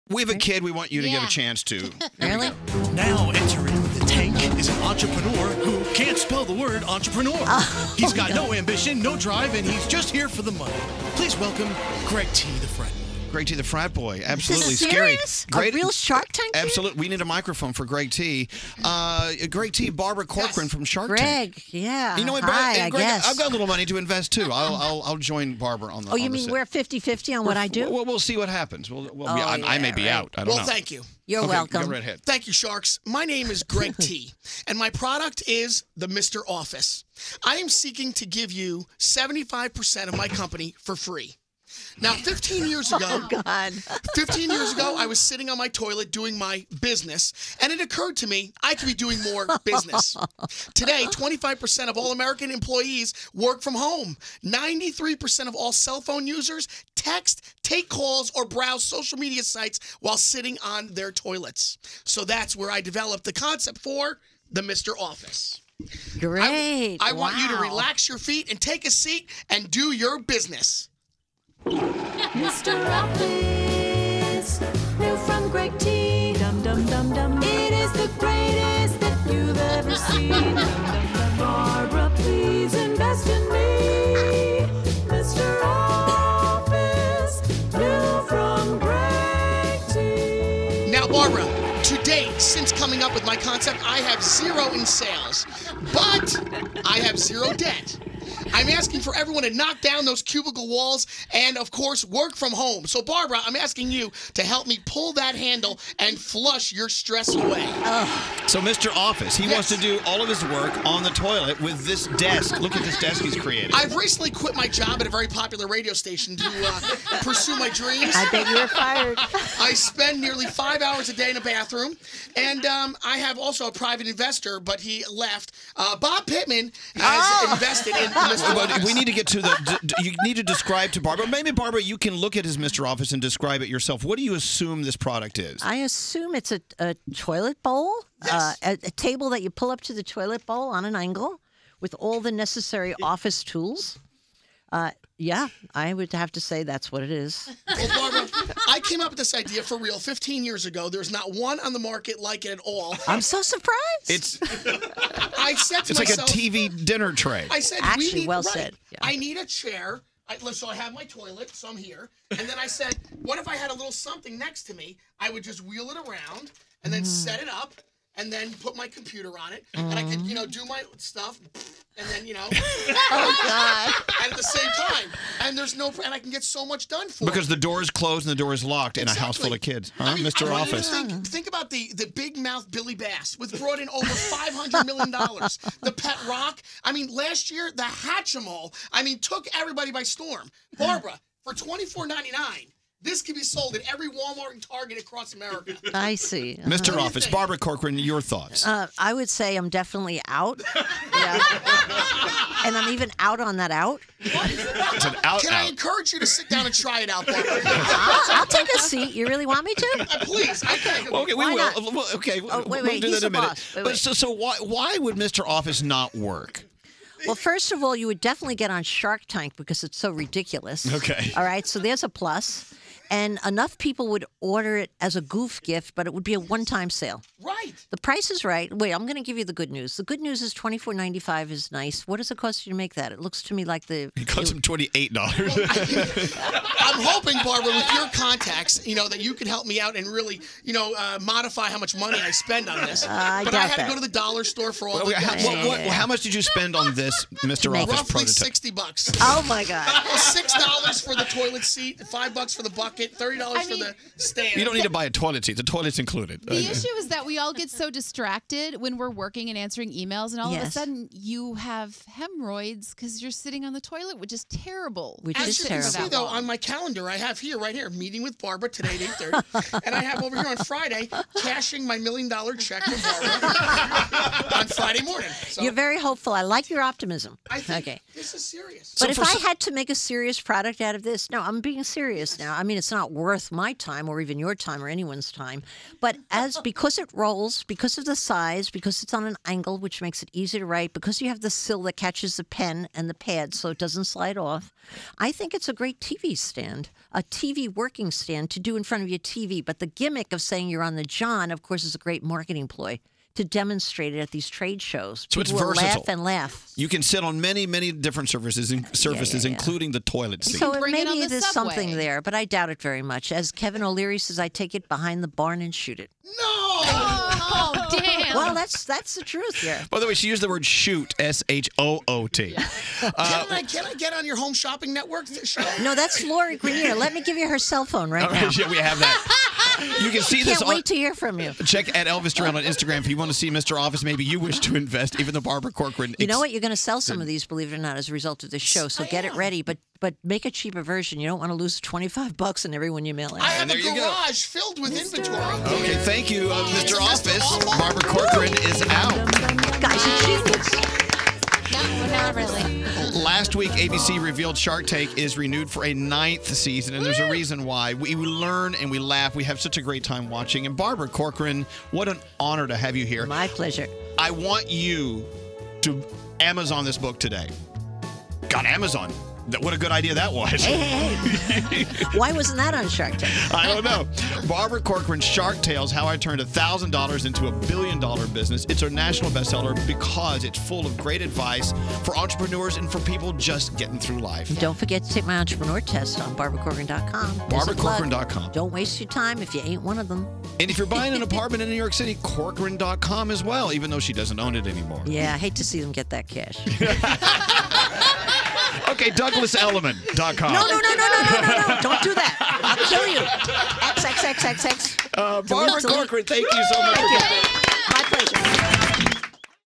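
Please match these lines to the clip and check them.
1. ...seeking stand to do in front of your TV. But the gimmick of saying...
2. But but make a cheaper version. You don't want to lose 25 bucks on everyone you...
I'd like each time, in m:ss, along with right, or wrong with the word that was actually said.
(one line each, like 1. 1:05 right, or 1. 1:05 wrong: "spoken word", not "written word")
1. 4:57 wrong: "working", not "seeking"
2. 5:39 right.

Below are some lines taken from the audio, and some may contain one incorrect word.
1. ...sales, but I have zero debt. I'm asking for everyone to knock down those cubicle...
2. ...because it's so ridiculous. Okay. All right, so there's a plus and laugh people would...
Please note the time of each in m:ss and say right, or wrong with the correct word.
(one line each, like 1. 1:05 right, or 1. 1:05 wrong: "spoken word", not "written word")
1. 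1:34 right
2. 3:39 wrong: "enough", not "laugh".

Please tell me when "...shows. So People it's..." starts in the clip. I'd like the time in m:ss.
5:04.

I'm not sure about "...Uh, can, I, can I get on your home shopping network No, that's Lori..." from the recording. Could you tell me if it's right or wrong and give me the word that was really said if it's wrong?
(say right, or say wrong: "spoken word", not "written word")
right.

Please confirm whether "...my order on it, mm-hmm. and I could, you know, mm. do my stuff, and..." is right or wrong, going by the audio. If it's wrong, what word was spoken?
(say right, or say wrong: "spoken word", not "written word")
wrong: "computer", not "order".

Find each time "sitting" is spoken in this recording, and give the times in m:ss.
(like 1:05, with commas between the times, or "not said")
0:45, 1:00, 4:23.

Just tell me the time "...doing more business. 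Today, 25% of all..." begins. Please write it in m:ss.
0:48.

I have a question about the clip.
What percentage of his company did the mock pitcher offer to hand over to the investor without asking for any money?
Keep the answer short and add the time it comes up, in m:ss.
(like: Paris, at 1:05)
75%, at 0:38.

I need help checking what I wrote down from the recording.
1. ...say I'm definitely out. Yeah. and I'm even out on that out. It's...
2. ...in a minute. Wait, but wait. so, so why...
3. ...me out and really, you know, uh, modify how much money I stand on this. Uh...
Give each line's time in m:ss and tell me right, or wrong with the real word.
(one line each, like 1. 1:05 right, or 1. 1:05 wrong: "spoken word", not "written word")
1. 3:19 right
2. 3:33 right
3. 3:59 wrong: "spend", not "stand".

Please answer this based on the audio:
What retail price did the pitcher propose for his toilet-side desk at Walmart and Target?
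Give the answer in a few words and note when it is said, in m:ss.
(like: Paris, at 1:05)
$24.99, at 3:11.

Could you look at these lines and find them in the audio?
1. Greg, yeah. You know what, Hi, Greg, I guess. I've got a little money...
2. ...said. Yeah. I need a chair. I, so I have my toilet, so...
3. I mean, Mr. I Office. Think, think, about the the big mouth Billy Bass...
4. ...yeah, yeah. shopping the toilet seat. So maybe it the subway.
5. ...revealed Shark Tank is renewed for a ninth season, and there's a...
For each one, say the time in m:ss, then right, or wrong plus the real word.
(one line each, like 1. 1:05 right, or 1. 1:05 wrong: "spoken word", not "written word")
1. 0:21 right
2. 2:38 right
3. 3:00 right
4. 5:09 wrong: "including", not "shopping"
5. 5:54 right.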